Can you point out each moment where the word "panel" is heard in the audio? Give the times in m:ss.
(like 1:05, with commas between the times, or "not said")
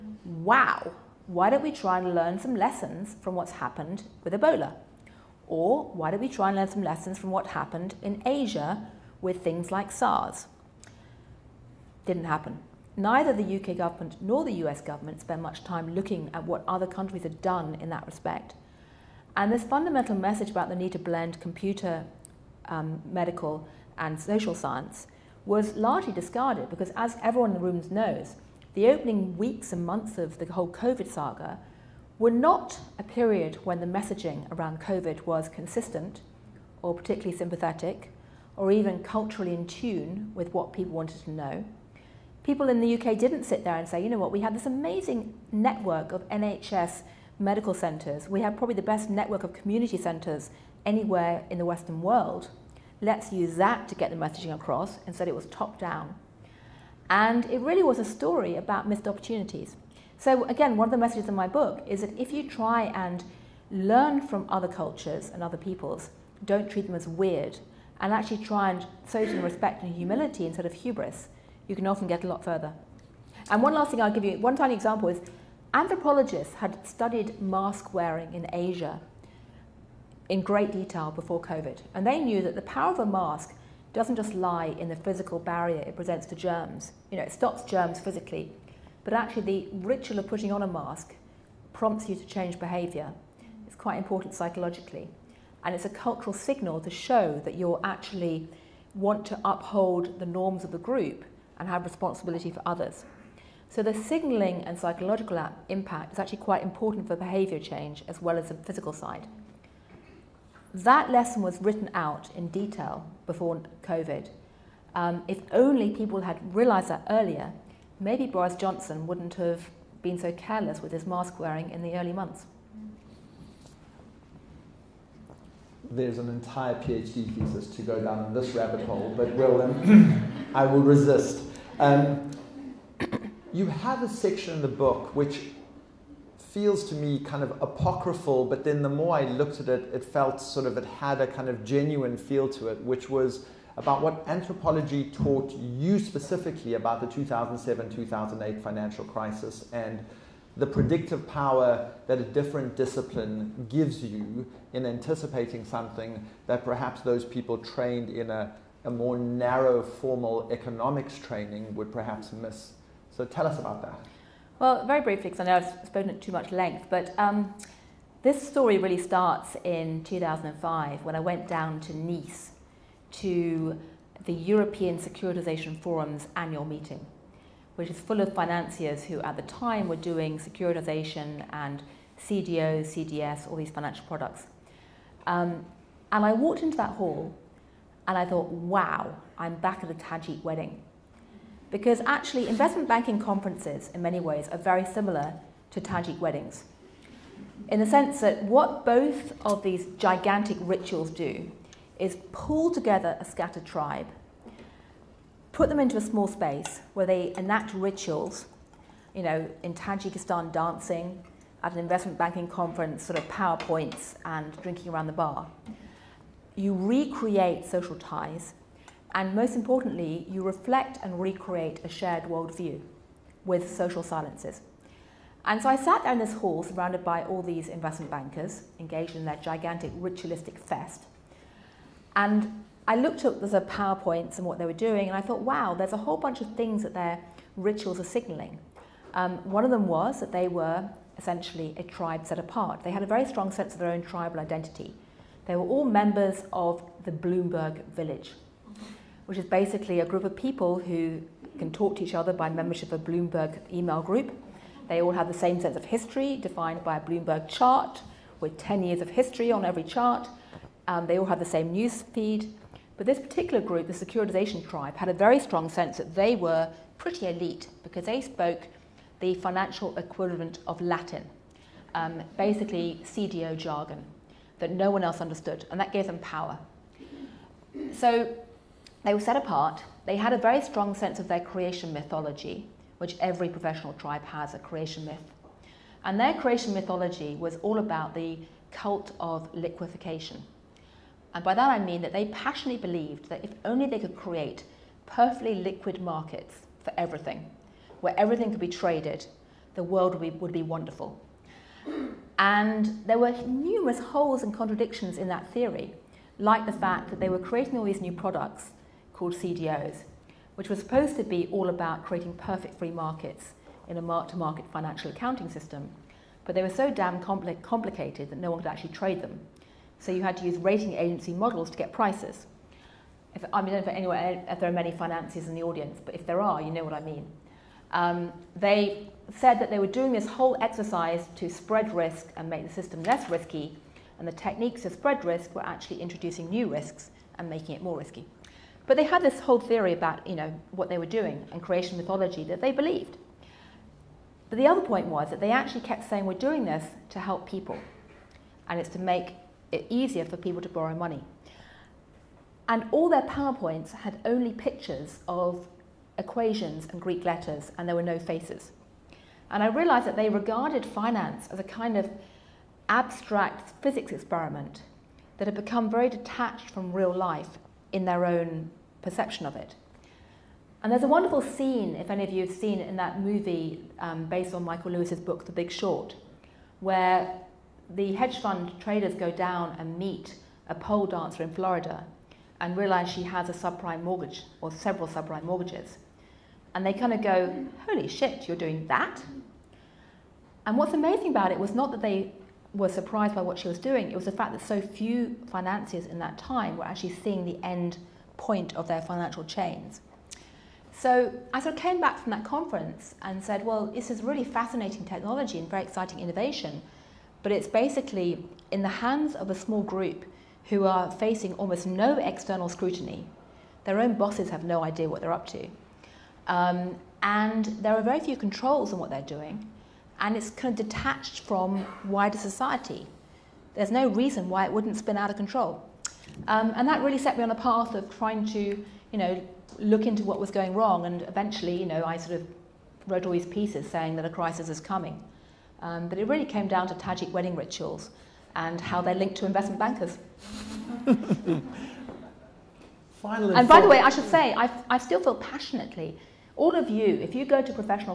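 not said.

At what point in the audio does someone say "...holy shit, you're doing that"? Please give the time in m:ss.
6:27.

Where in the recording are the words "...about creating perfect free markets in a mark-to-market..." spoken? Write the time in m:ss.
5:11.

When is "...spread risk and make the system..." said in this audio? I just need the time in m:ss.
5:31.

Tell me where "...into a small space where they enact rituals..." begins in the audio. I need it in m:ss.
3:25.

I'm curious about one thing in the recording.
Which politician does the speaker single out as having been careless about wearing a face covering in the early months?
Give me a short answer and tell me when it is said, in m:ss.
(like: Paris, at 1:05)
Boris Johnson, at 1:58.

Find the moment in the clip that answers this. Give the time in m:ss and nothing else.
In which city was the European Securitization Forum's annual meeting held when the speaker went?
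2:51.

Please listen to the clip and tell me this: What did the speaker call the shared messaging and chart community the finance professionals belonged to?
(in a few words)
Bloomberg village.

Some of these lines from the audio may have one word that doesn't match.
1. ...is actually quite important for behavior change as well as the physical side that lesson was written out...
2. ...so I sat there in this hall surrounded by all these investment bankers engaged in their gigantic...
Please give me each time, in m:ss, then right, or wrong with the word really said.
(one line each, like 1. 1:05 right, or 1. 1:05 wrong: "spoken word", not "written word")
1. 1:46 right
2. 3:45 right.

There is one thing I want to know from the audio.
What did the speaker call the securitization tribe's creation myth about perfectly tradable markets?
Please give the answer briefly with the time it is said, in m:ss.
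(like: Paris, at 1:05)
cult of liquefaction, at 4:48.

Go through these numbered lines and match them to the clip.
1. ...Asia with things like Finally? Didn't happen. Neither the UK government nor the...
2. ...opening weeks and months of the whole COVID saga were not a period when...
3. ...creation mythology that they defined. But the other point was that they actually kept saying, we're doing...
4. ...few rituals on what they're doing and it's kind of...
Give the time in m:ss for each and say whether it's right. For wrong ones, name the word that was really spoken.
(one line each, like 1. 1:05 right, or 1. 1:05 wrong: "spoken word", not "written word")
1. 0:08 wrong: "SARS", not "Finally"
2. 0:28 right
3. 5:41 wrong: "believed", not "defined"
4. 6:58 wrong: "controls", not "rituals".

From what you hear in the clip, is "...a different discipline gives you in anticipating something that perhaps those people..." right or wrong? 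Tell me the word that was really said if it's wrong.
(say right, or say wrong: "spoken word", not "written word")
right.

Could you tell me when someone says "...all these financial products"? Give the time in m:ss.
3:03.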